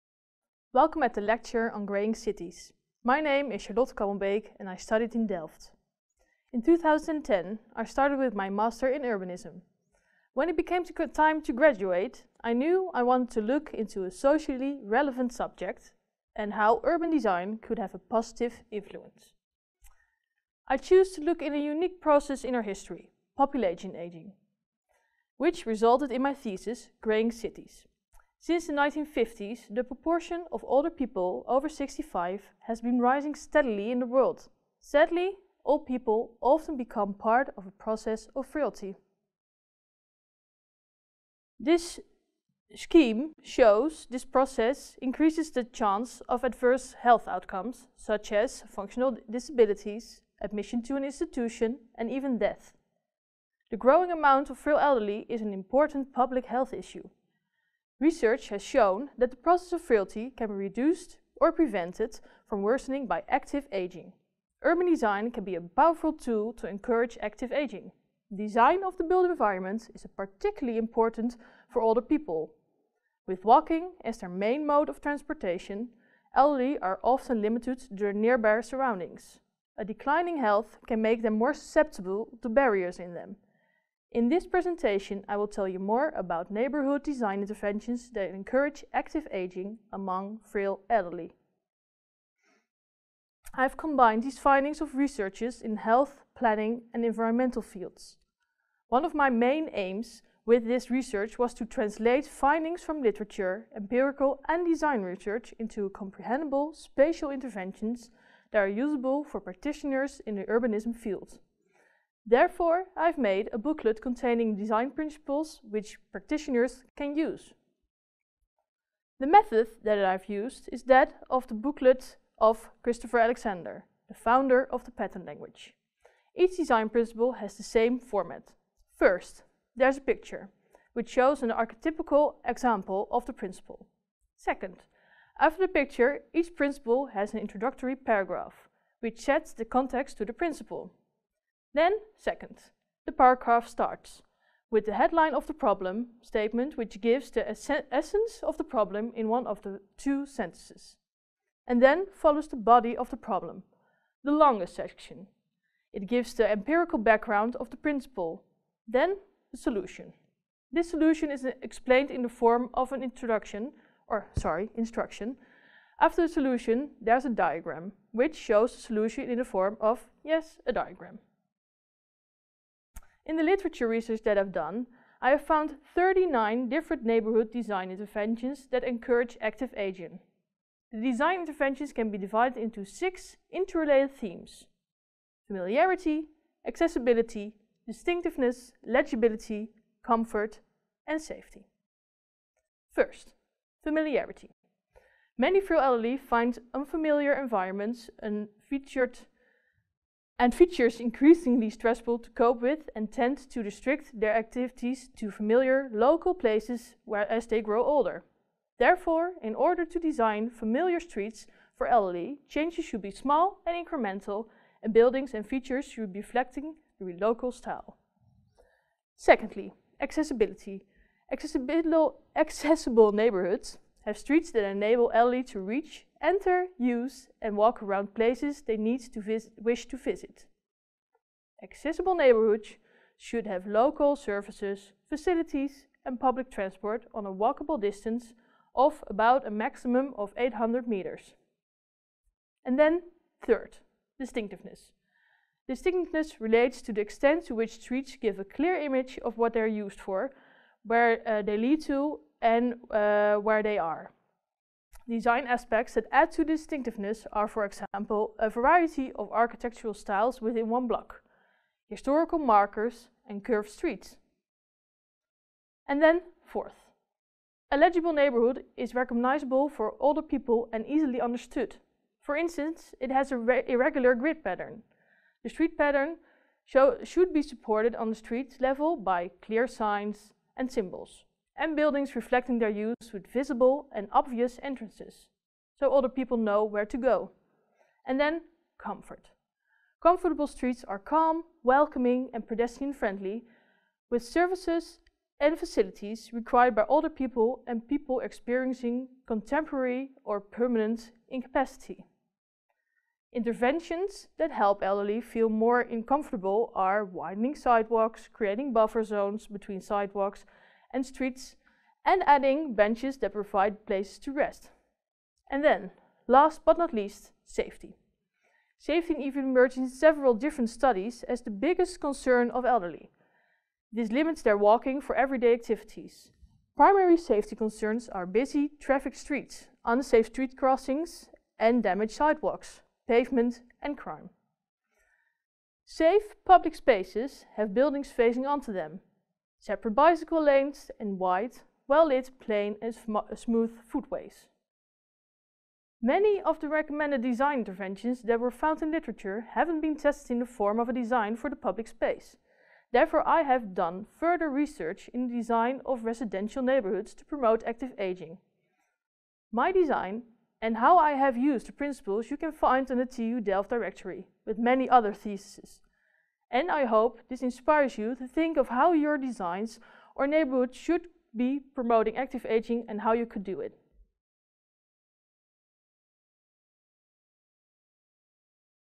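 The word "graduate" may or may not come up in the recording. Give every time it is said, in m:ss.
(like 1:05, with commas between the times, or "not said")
0:11.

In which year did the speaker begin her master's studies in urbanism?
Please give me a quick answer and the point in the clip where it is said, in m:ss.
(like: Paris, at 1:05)
2010, at 0:06.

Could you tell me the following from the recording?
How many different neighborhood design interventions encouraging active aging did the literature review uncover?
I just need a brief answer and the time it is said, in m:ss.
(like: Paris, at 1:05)
39, at 2:55.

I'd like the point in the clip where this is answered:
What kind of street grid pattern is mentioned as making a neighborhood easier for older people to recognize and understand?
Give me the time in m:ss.
4:33.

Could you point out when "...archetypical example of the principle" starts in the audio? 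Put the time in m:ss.
2:11.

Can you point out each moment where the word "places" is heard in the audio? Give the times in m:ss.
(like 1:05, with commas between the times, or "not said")
3:26, 3:48, 5:13.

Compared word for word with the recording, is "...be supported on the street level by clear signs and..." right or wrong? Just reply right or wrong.
right.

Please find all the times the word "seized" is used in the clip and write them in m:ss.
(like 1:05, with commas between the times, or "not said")
not said.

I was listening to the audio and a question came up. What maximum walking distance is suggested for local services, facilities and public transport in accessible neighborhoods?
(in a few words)
800 meters.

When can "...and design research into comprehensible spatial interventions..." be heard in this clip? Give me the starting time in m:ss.
1:44.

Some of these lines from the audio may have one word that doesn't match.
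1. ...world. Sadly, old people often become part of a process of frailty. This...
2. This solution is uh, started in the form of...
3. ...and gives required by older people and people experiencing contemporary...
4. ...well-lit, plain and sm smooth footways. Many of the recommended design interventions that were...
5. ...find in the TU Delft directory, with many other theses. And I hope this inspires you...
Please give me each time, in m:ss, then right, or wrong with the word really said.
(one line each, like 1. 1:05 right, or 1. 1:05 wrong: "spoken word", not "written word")
1. 0:34 right
2. 2:40 wrong: "explained", not "started"
3. 4:55 wrong: "facilities", not "gives"
4. 5:41 right
5. 6:02 right.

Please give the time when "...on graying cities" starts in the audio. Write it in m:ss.
0:01.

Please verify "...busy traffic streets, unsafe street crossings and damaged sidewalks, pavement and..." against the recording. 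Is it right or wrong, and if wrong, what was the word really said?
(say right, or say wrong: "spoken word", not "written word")
right.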